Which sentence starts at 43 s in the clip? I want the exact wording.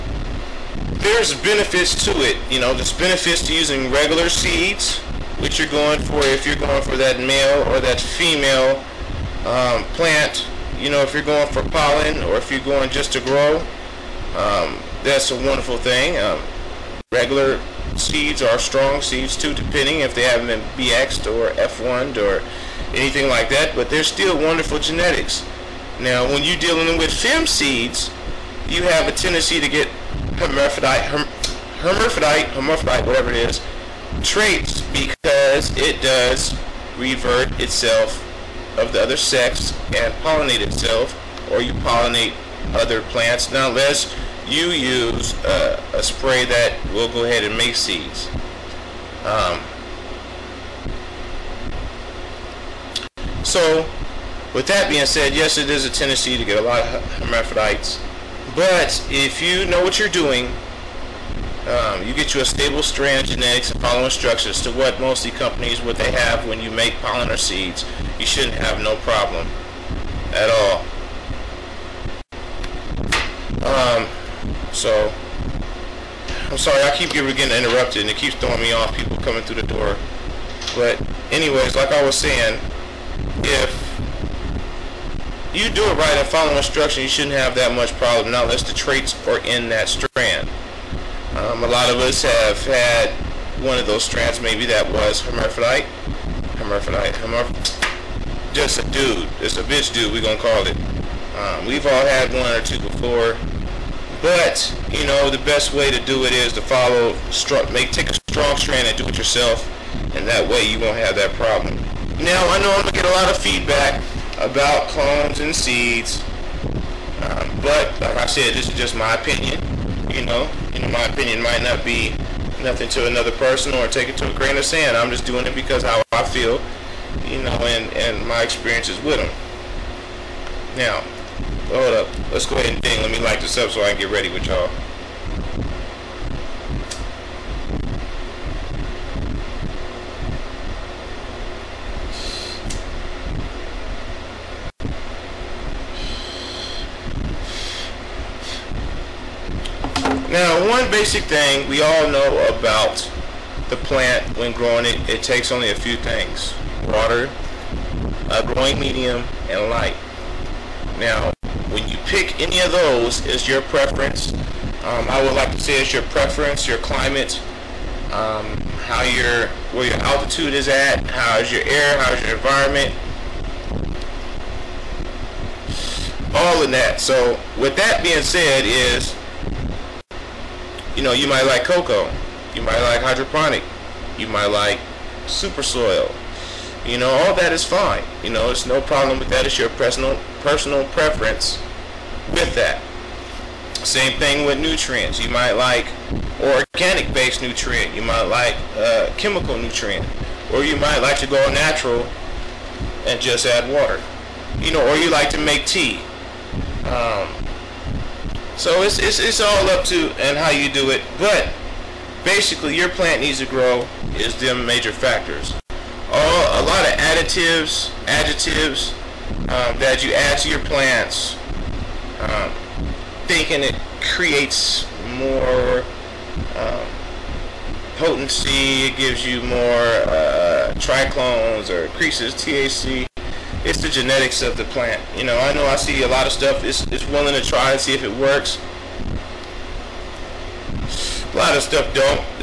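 Now, unless you use uh, a spray that will go ahead and make seeds.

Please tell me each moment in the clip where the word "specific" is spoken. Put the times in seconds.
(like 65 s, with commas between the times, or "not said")
not said.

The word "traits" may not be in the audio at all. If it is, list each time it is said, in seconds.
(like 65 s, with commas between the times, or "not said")
34 s, 88 s.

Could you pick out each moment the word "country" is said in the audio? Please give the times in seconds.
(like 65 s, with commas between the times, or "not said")
not said.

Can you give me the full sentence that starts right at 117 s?
Um, but like I said, this is just my opinion.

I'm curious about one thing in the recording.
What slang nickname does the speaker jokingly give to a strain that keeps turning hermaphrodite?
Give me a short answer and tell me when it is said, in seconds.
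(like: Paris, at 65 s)
bitch dude, at 99 s.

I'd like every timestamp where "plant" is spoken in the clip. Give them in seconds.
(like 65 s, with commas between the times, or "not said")
9 s, 43 s, 153 s, 212 s, 220 s, 234 s.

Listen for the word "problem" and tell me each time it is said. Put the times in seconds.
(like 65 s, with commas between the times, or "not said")
68 s, 87 s, 111 s, 188 s.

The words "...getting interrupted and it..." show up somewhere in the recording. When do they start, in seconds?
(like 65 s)
77 s.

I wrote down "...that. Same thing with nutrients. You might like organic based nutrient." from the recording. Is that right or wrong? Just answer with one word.
right.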